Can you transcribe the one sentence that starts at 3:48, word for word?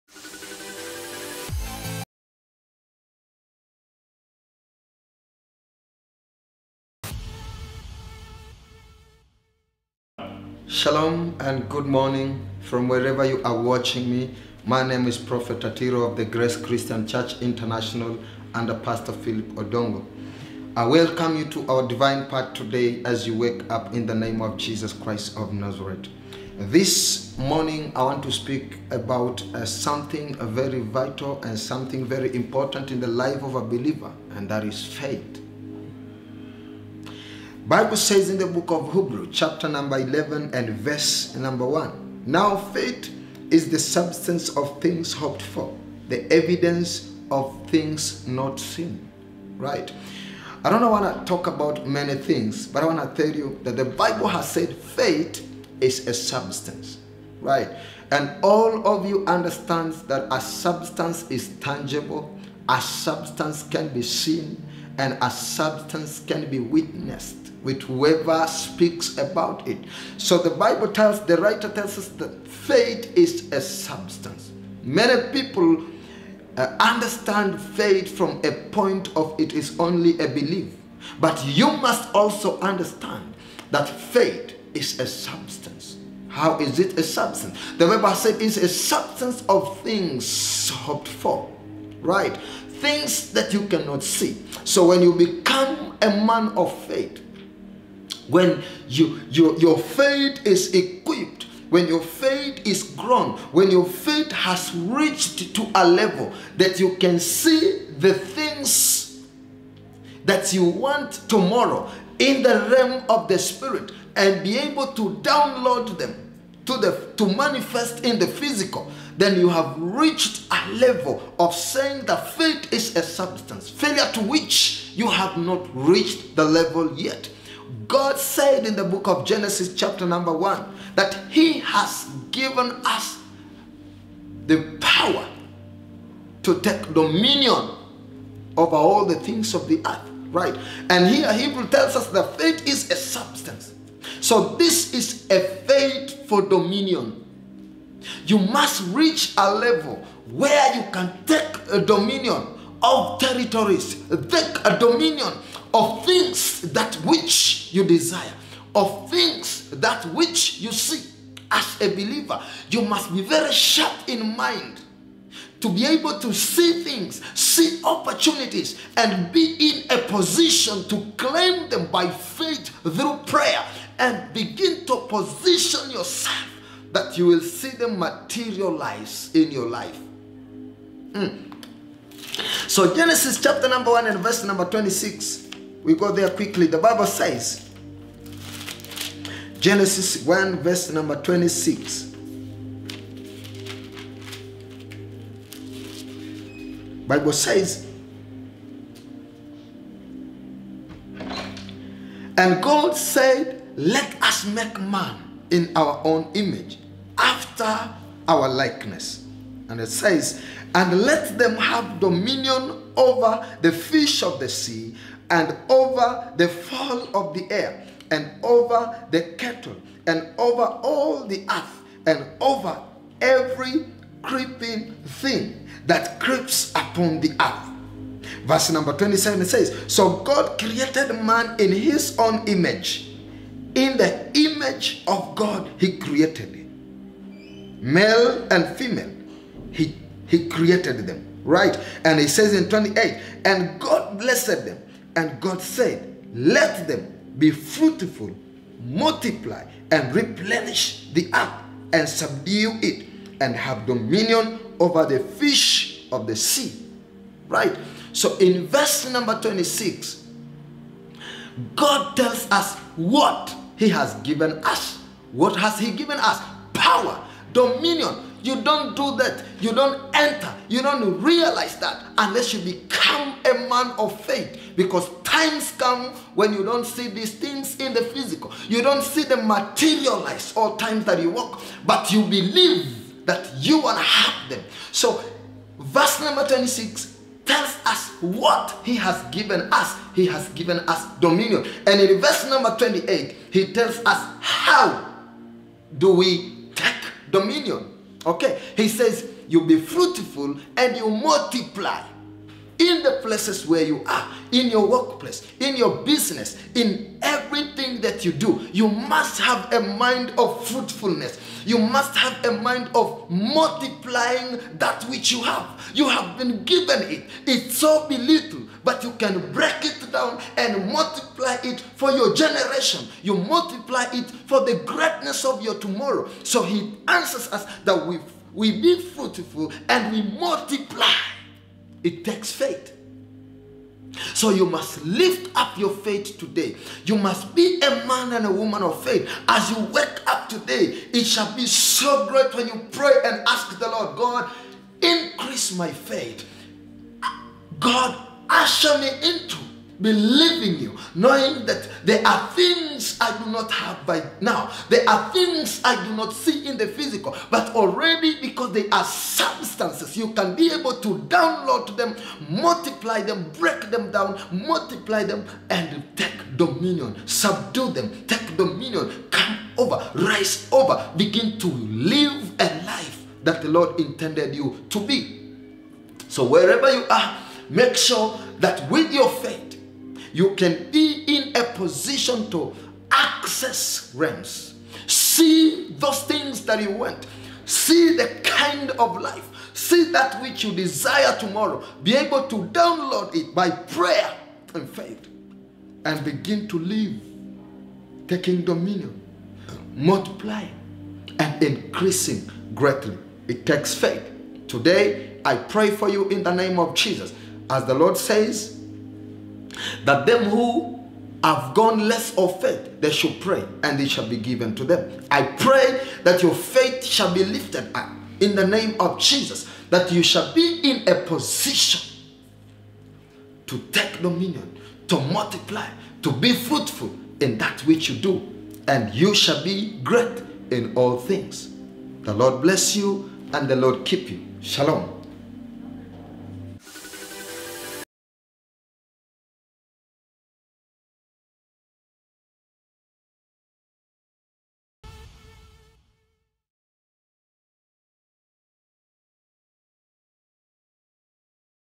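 Verse number 27 says, So God created man in his own image.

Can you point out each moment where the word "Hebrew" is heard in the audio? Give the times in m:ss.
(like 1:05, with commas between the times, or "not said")
0:38, 2:21.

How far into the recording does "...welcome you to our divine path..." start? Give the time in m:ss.
0:20.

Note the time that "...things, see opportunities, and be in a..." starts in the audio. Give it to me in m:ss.
2:46.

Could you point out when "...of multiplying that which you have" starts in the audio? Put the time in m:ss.
5:12.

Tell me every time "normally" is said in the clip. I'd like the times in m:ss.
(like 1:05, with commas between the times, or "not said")
not said.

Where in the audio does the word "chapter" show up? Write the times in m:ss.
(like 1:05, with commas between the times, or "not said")
0:39, 2:09, 3:03.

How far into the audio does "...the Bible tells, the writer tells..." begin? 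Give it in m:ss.
1:10.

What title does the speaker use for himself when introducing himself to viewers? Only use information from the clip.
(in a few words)
Prophet.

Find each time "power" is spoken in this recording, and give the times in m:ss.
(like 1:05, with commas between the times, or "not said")
2:14, 4:26.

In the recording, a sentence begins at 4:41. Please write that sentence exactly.
But you believe that you will have them.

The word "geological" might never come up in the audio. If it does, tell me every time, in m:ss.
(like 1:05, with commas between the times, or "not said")
not said.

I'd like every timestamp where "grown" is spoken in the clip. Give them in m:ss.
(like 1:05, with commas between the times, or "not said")
1:42.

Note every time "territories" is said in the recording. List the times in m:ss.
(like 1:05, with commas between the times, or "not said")
2:33.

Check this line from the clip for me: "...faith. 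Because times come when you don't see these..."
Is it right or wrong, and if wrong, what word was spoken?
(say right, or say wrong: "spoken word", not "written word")
right.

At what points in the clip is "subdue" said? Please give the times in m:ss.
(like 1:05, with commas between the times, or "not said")
4:12, 6:07.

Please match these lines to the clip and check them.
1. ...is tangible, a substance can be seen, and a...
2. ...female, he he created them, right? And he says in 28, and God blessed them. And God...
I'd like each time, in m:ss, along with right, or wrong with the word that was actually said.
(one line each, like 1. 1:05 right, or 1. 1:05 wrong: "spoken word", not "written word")
1. 1:01 right
2. 3:58 right.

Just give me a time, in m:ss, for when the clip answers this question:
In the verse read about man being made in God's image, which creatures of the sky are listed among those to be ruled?
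3:36.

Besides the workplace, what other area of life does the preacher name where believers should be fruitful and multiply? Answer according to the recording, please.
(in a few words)
business.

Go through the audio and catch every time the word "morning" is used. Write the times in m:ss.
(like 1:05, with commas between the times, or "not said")
0:11, 0:27.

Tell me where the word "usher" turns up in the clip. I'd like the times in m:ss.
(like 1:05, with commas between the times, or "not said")
5:48.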